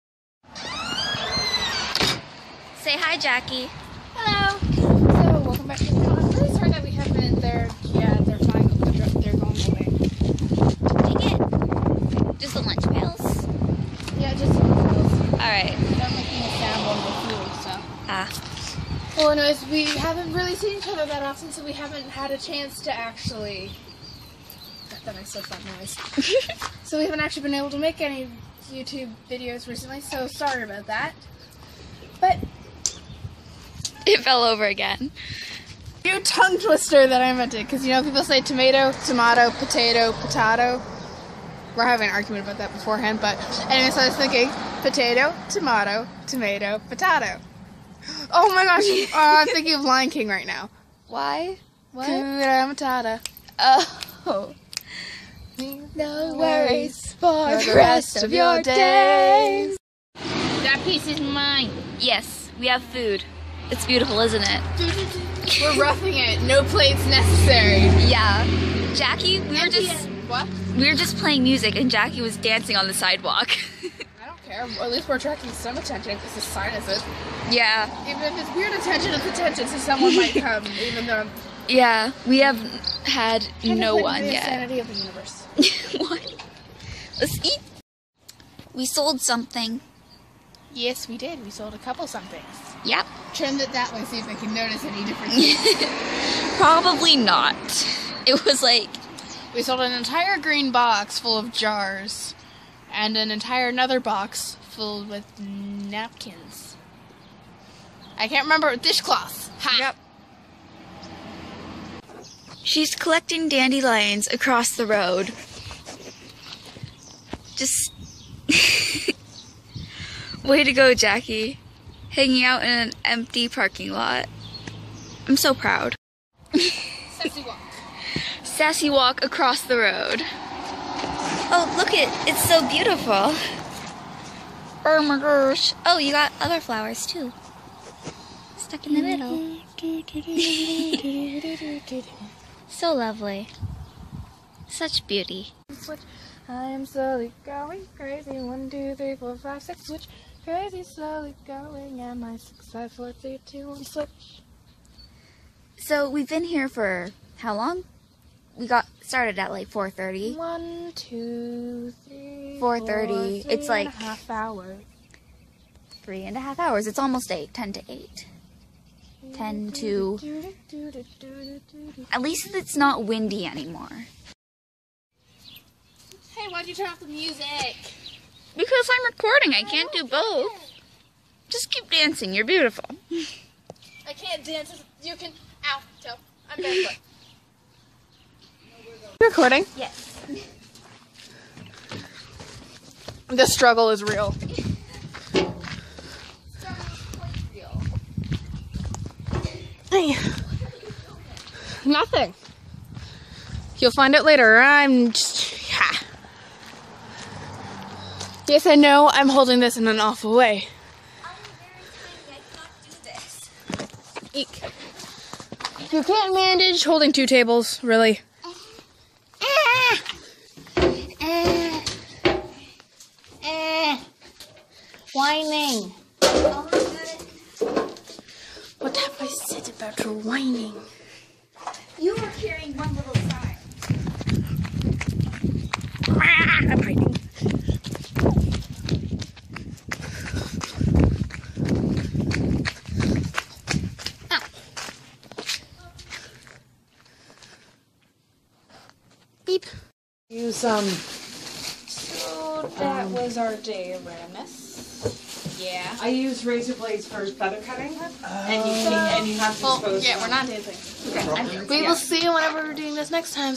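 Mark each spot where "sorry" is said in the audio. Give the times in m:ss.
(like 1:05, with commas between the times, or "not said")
0:06, 0:30.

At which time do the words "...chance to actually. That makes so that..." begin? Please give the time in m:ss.
0:22.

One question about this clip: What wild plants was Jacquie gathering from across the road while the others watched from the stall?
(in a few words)
dandelions.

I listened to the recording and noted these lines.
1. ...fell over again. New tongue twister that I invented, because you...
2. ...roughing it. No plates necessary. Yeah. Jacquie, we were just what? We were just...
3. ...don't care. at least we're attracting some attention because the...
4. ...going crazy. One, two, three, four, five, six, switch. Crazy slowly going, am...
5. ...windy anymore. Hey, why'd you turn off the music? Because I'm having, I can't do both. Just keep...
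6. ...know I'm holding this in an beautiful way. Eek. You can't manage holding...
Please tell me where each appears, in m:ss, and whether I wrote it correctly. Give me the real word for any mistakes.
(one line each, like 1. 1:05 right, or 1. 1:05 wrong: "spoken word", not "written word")
1. 0:34 right
2. 1:05 right
3. 1:14 right
4. 2:27 right
5. 2:53 wrong: "recording", not "having"
6. 3:28 wrong: "awful", not "beautiful".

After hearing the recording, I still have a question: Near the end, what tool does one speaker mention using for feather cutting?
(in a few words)
razor blades.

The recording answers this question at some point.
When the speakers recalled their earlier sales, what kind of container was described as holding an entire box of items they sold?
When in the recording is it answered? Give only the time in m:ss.
1:41.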